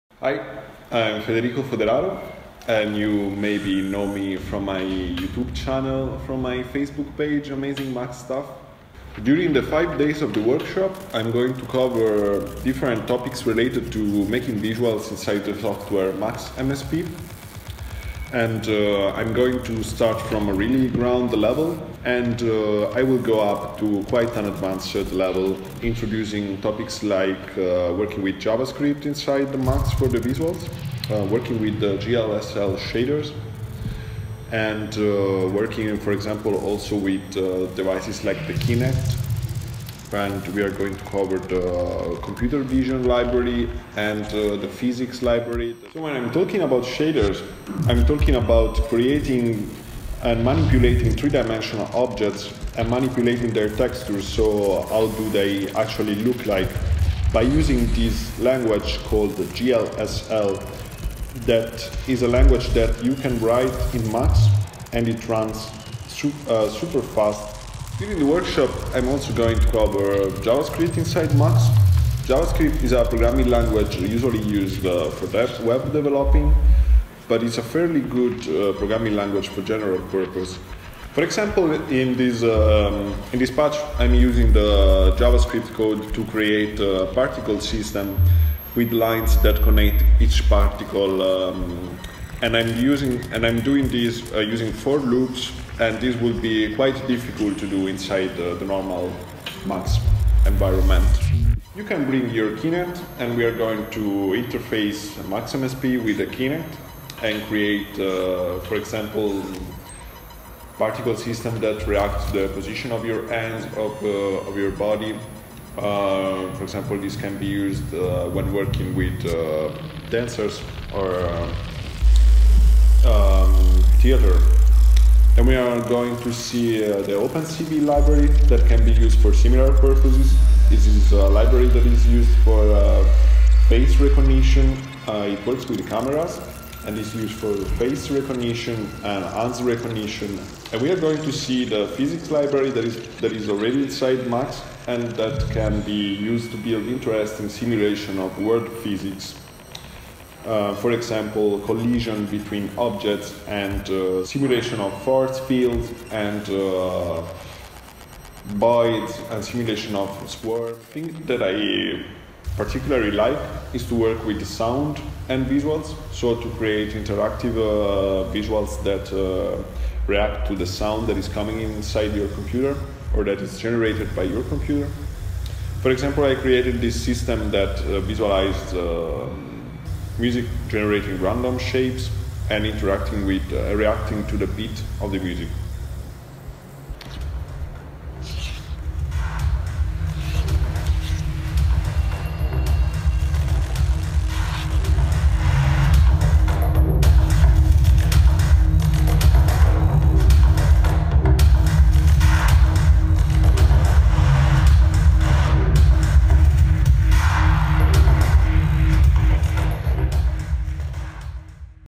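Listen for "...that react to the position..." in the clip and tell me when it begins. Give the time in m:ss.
1:51.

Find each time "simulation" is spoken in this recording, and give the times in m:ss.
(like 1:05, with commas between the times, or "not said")
2:27, 2:34, 2:39.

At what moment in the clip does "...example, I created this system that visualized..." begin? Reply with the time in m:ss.
2:55.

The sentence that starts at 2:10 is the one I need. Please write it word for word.
This is a library that is used for uh, face recognition.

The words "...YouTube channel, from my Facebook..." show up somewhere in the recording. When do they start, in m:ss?
0:04.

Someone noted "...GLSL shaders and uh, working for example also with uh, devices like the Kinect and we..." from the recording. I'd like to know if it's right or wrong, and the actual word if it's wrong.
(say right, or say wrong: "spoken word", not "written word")
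right.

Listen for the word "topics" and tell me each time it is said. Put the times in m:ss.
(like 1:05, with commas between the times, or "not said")
0:13, 0:26.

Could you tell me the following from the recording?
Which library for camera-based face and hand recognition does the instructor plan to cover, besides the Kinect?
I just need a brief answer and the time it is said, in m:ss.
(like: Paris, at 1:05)
OpenCV, at 2:07.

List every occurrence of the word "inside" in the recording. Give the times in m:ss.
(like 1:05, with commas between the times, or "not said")
0:15, 0:29, 1:10, 1:37, 2:23, 2:51.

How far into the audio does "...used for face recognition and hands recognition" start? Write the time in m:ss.
2:17.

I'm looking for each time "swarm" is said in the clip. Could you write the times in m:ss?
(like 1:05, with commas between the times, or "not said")
2:40.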